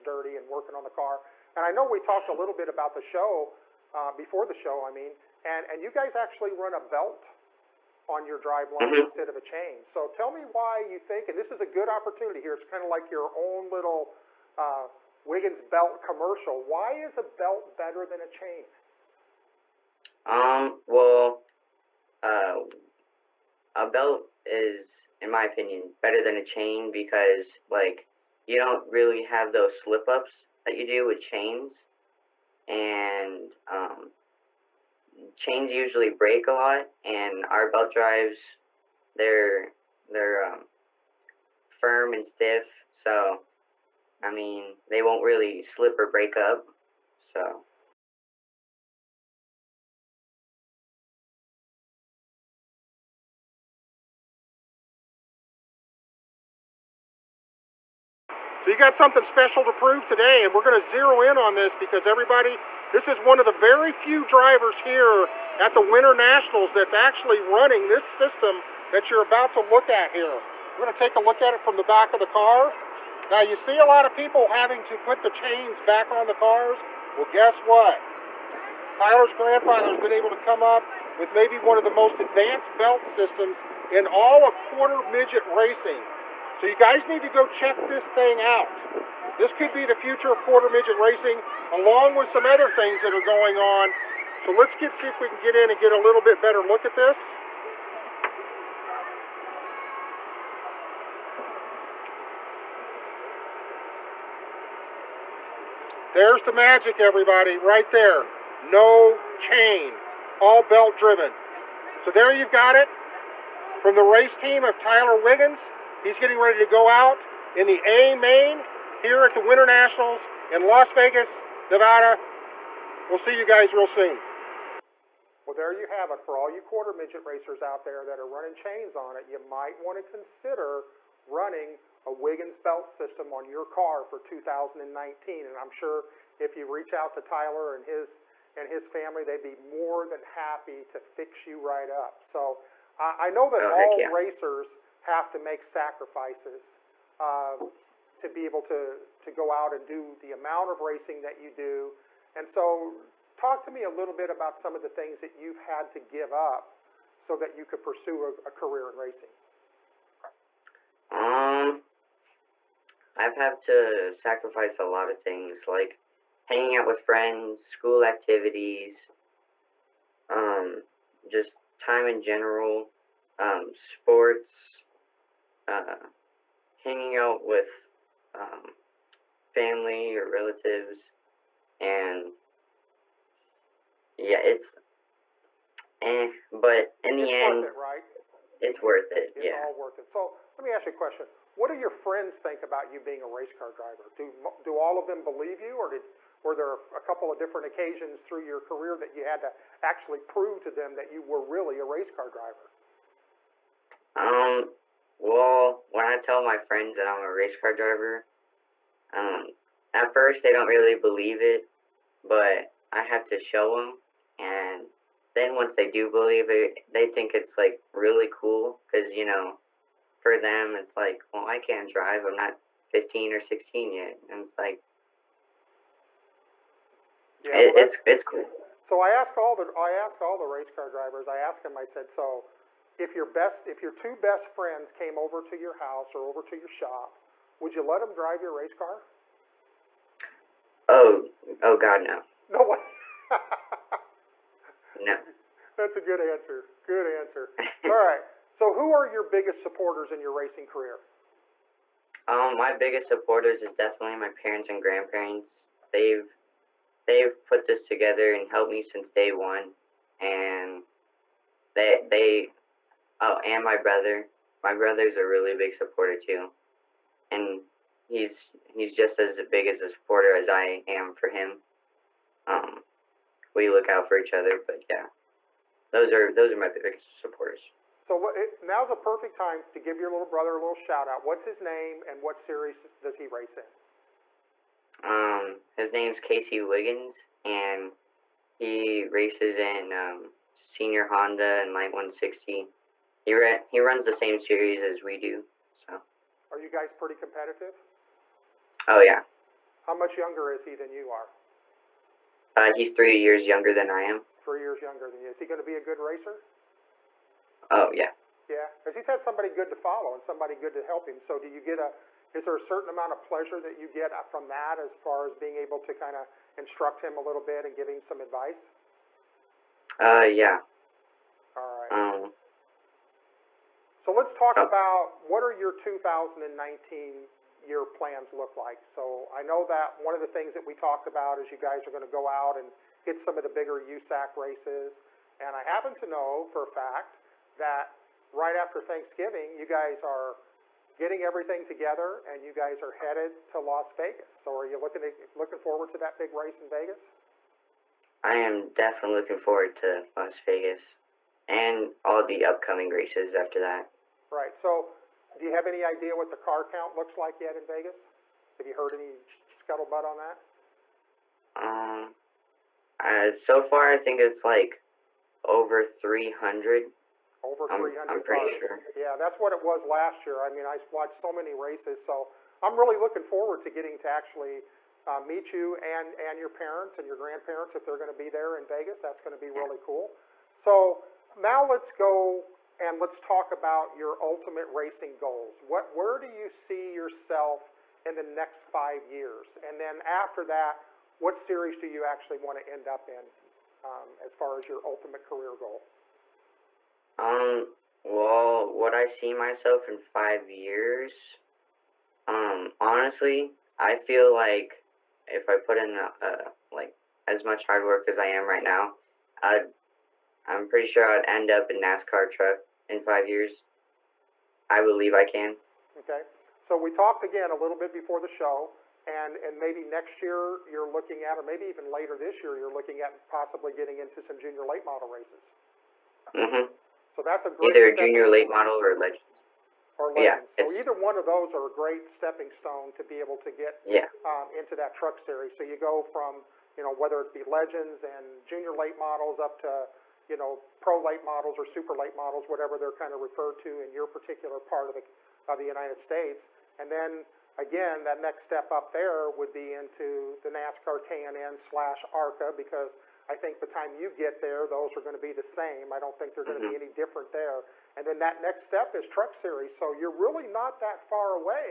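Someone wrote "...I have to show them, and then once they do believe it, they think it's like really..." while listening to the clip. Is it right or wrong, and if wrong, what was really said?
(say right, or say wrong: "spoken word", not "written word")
right.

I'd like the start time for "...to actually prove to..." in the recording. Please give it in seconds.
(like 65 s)
199 s.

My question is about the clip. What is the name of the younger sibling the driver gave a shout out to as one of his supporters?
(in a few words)
Casey Wiggans.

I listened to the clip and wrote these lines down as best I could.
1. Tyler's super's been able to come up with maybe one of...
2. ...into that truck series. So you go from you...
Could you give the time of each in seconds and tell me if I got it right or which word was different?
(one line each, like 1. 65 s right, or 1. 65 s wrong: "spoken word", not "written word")
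1. 78 s wrong: "grandfather", not "super"
2. 434 s right.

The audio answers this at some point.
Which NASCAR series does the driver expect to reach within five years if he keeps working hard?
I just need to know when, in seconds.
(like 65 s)
411 s.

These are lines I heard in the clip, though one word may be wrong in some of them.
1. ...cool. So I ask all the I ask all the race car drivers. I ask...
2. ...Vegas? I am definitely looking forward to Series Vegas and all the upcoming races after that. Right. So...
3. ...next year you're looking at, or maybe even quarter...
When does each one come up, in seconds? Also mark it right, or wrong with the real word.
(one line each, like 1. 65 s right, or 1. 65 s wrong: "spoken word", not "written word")
1. 228 s right
2. 346 s wrong: "Las", not "Series"
3. 419 s wrong: "later", not "quarter".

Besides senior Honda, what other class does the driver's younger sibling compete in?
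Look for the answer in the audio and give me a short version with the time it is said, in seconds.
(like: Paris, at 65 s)
Light 160, at 291 s.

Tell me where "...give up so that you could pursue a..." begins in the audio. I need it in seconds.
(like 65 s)
156 s.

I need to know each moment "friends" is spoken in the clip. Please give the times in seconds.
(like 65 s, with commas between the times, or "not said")
167 s, 191 s, 206 s, 234 s.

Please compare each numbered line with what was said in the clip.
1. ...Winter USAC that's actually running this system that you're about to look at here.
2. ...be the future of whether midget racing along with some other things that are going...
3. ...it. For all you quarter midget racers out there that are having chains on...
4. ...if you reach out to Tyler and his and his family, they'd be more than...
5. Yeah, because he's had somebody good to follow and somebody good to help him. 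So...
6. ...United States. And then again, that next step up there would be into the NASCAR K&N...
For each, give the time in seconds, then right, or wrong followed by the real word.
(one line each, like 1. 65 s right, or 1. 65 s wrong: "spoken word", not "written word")
1. 65 s wrong: "Nationals", not "USAC"
2. 89 s wrong: "quarter", not "whether"
3. 126 s wrong: "running", not "having"
4. 136 s right
5. 308 s right
6. 445 s right.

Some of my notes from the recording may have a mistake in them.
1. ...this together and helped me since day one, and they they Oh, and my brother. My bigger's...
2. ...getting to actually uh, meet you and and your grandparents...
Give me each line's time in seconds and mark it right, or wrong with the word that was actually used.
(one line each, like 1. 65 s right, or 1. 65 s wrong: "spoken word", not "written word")
1. 257 s wrong: "brother", not "bigger"
2. 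373 s wrong: "parents", not "grandparents".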